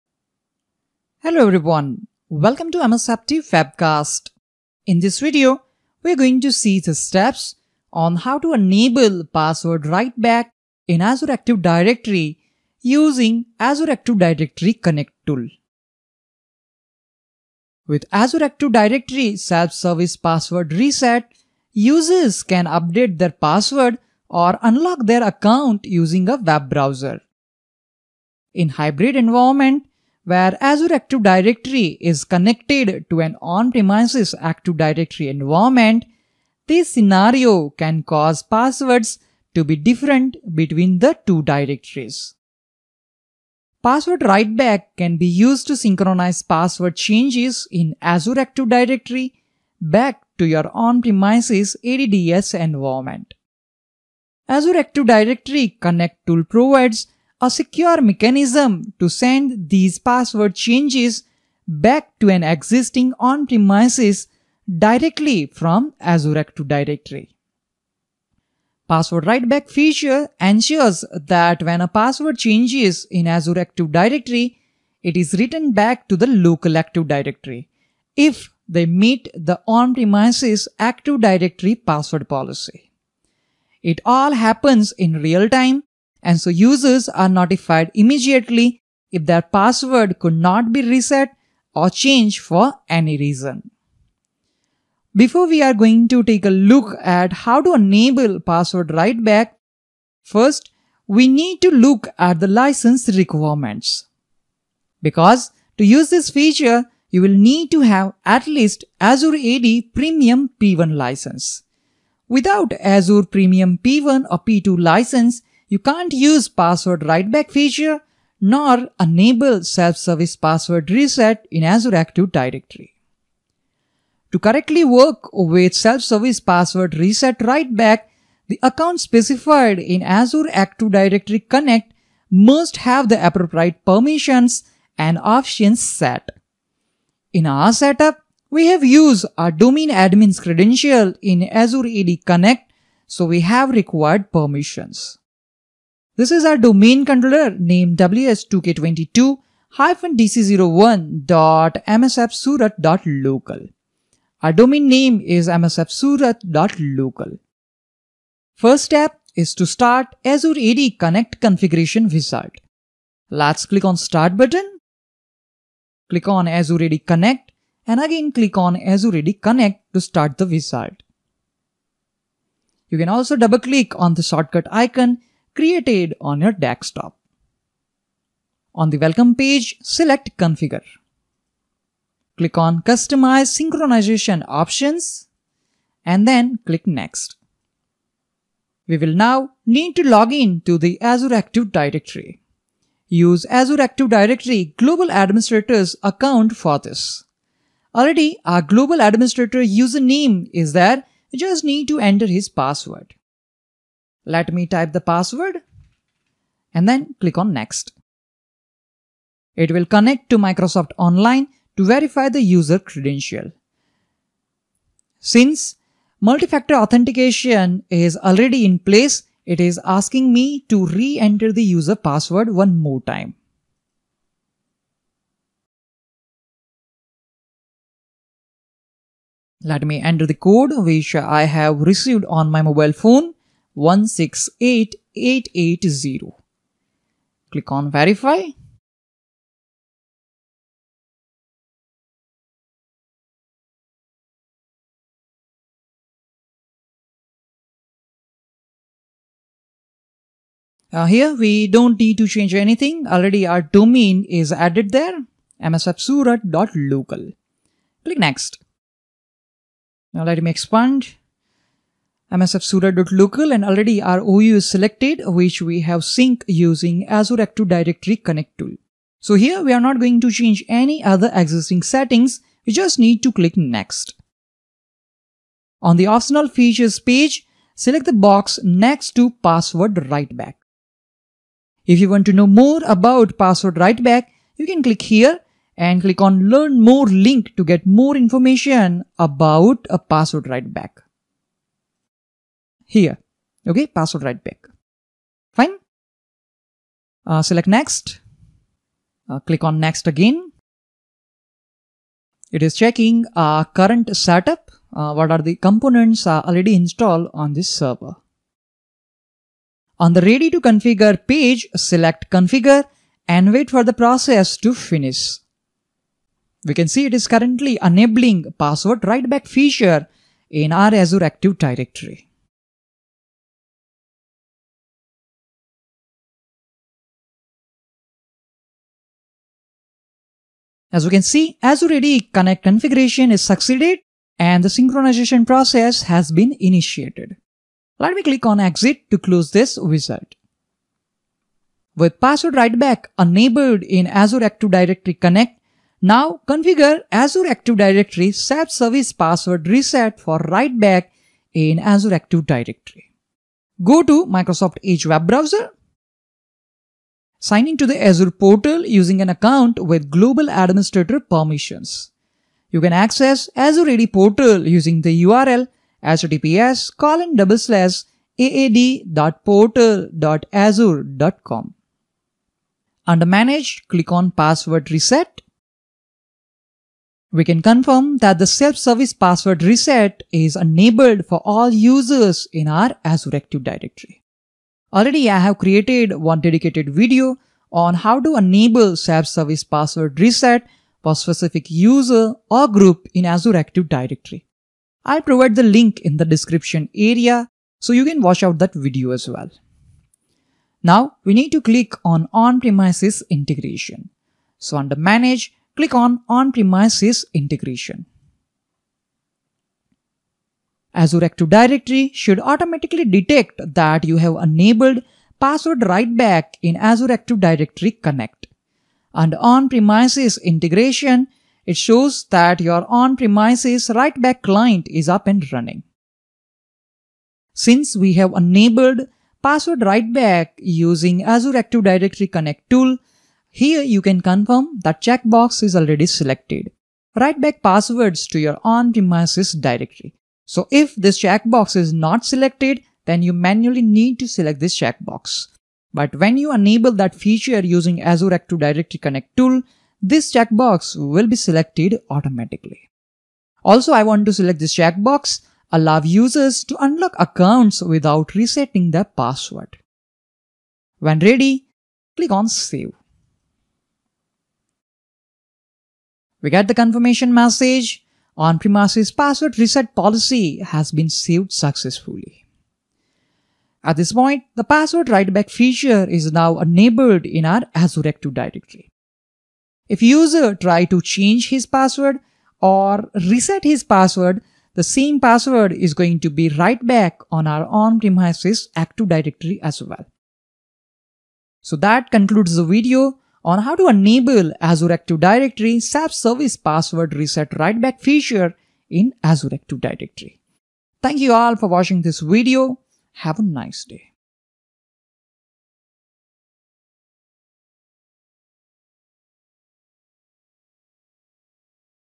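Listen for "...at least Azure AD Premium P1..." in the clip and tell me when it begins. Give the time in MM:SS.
01:48.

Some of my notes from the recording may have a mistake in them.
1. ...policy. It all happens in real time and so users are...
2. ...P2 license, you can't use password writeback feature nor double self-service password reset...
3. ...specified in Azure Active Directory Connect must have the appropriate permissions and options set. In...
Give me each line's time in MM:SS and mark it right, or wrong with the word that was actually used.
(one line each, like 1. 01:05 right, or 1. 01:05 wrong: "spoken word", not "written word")
1. 01:22 right
2. 01:54 wrong: "enable", not "double"
3. 02:08 right.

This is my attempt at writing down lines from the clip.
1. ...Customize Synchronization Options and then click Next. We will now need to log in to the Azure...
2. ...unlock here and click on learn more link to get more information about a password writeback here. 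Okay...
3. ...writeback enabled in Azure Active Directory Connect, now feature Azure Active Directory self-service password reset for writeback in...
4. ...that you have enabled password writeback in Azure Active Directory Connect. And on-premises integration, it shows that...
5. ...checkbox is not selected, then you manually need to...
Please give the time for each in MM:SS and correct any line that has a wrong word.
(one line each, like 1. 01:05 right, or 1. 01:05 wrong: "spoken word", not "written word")
1. 03:02 right
2. 04:44 wrong: "click", not "unlock"
3. 05:42 wrong: "configure", not "feature"
4. 06:53 right
5. 07:21 right.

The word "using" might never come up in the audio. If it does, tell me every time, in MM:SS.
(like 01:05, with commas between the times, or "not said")
00:12, 00:25, 04:26, 05:58, 06:04, 07:10, 07:27.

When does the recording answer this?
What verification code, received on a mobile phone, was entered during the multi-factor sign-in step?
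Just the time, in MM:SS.
03:53.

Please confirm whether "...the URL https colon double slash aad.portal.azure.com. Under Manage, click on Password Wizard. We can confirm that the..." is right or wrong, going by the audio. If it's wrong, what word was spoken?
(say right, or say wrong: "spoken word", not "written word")
wrong: "Reset", not "Wizard".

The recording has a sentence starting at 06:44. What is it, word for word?
So under manage, click on on-premises integration.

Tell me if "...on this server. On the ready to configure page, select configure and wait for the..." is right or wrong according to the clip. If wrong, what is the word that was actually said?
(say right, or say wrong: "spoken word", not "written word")
right.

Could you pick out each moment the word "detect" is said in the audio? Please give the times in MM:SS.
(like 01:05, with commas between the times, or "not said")
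06:53.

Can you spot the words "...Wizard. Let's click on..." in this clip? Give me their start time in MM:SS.
02:42.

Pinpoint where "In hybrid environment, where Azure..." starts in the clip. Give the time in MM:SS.
00:28.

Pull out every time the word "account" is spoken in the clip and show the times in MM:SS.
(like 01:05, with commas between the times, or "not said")
00:25, 02:08, 03:16, 05:59, 07:37.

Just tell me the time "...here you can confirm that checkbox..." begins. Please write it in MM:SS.
07:13.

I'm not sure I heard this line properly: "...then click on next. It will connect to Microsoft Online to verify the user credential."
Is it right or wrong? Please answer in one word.
right.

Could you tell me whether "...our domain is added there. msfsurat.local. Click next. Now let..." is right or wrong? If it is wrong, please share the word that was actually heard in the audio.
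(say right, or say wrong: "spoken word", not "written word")
right.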